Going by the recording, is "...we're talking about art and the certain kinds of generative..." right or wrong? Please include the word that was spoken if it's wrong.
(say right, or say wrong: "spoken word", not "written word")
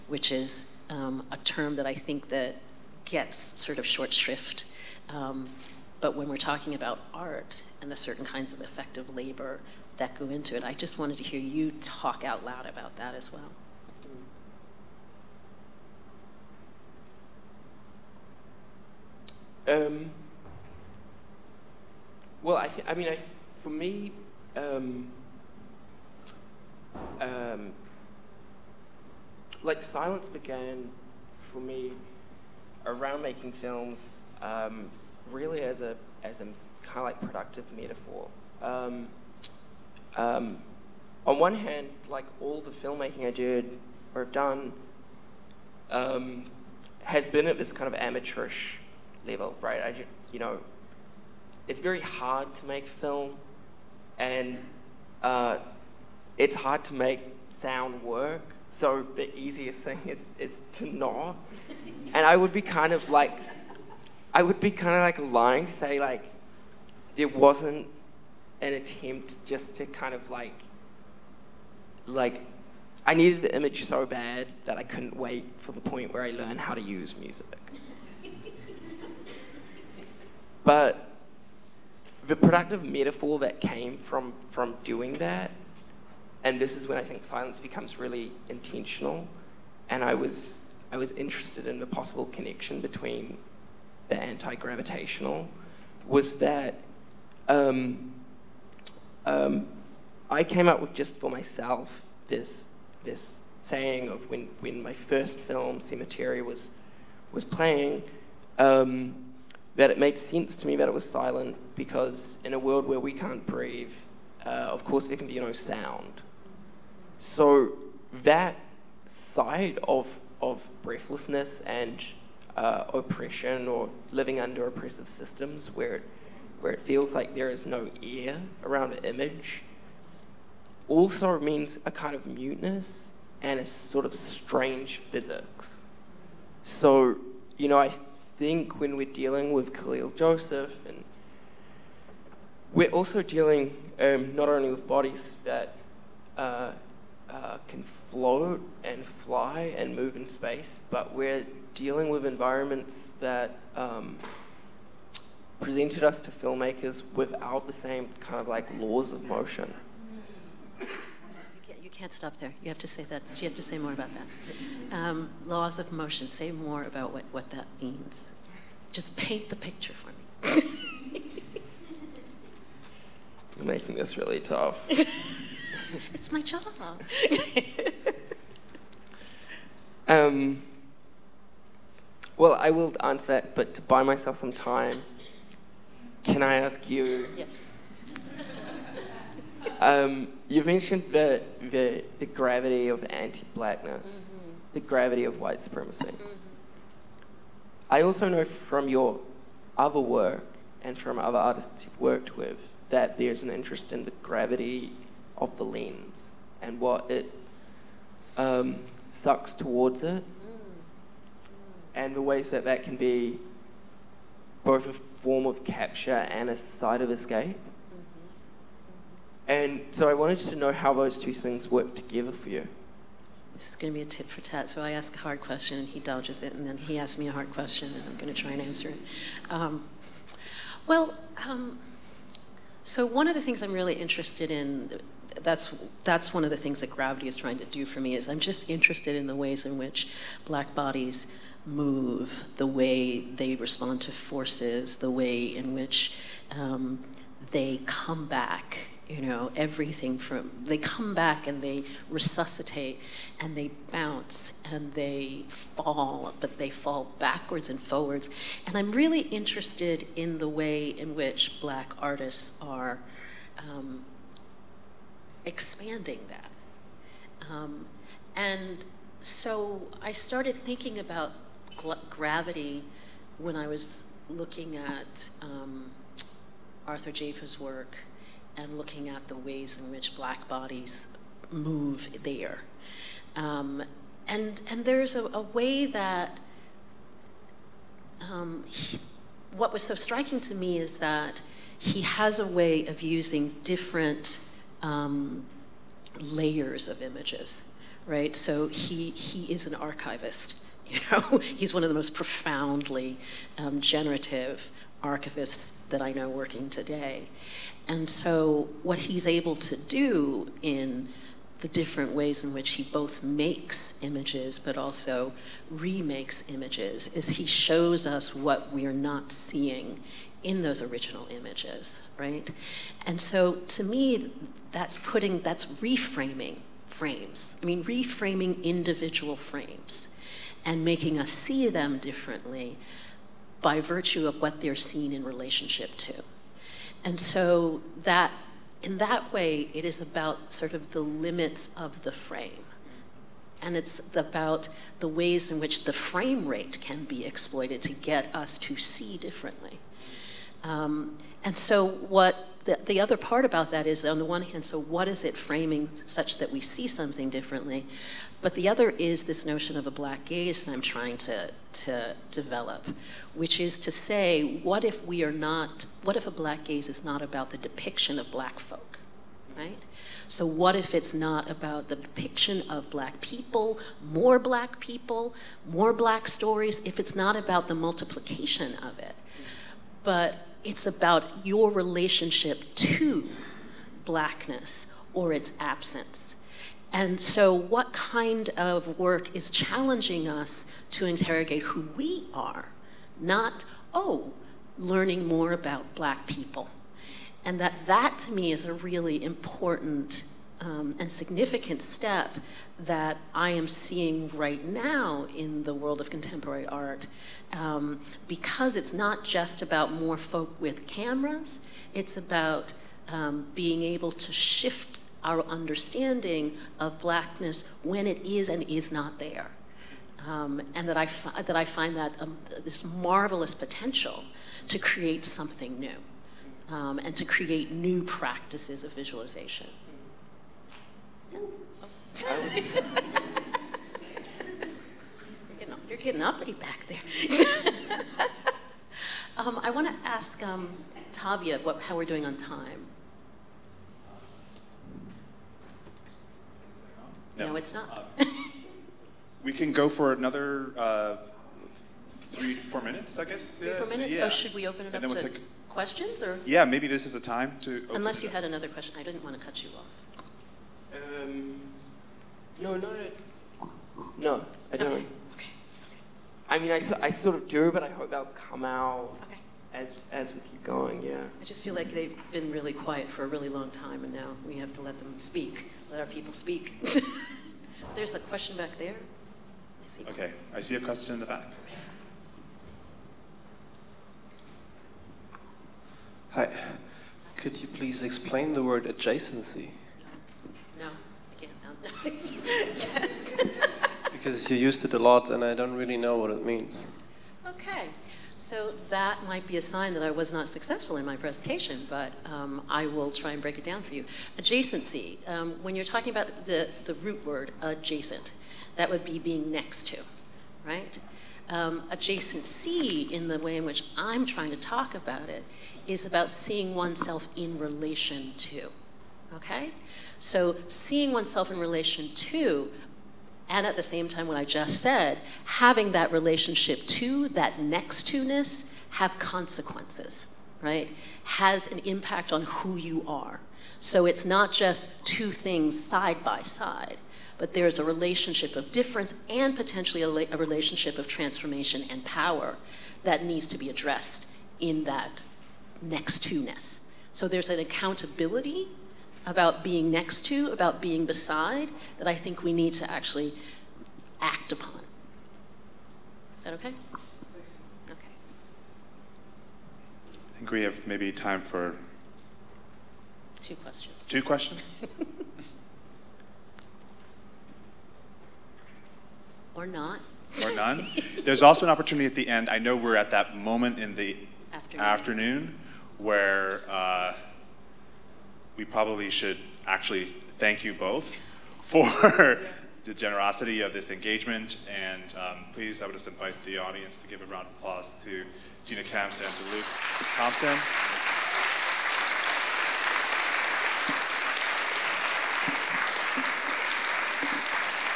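wrong: "effective", not "generative".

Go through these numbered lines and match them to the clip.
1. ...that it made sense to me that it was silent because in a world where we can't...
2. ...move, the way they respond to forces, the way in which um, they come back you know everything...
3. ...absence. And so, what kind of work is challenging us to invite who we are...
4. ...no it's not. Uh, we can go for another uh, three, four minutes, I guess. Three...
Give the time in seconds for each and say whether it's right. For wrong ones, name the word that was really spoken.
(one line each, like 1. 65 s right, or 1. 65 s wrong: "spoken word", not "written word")
1. 109 s right
2. 241 s right
3. 385 s wrong: "interrogate", not "invite"
4. 447 s right.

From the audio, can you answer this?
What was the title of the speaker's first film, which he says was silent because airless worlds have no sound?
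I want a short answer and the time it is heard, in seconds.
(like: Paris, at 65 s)
Cemetery, at 105 s.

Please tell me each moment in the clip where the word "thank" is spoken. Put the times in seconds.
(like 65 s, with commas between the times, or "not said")
580 s.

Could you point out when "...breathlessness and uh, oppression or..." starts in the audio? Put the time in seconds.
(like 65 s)
120 s.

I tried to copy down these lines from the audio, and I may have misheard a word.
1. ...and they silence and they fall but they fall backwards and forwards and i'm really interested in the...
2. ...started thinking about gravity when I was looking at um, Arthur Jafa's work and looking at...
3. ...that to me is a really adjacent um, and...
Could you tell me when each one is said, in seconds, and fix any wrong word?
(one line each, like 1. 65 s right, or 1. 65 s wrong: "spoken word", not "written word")
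1. 253 s wrong: "bounce", not "silence"
2. 270 s right
3. 397 s wrong: "important", not "adjacent".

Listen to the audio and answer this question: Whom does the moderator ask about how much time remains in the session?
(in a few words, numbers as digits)
Tavia.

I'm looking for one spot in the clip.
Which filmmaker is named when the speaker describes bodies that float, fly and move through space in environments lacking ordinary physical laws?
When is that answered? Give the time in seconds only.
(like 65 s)
139 s.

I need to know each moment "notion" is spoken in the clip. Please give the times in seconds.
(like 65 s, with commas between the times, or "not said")
359 s.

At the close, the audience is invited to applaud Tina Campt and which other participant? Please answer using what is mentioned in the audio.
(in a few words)
Luke Thompson.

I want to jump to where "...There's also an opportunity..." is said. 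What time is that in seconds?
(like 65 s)
571 s.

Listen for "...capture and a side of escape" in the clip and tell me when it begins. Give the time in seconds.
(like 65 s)
215 s.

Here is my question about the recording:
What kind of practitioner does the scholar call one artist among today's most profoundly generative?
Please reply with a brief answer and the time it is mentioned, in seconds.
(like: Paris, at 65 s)
archivist, at 305 s.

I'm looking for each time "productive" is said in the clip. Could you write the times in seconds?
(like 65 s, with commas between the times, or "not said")
37 s, 82 s.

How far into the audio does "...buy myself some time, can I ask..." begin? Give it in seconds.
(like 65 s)
183 s.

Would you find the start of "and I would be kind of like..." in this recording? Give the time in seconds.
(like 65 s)
62 s.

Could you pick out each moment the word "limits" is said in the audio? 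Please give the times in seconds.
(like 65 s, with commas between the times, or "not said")
340 s.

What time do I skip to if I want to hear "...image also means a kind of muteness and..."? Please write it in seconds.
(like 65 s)
129 s.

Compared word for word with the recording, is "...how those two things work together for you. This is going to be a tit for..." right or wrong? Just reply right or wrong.
right.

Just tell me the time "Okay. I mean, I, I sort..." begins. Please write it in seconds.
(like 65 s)
464 s.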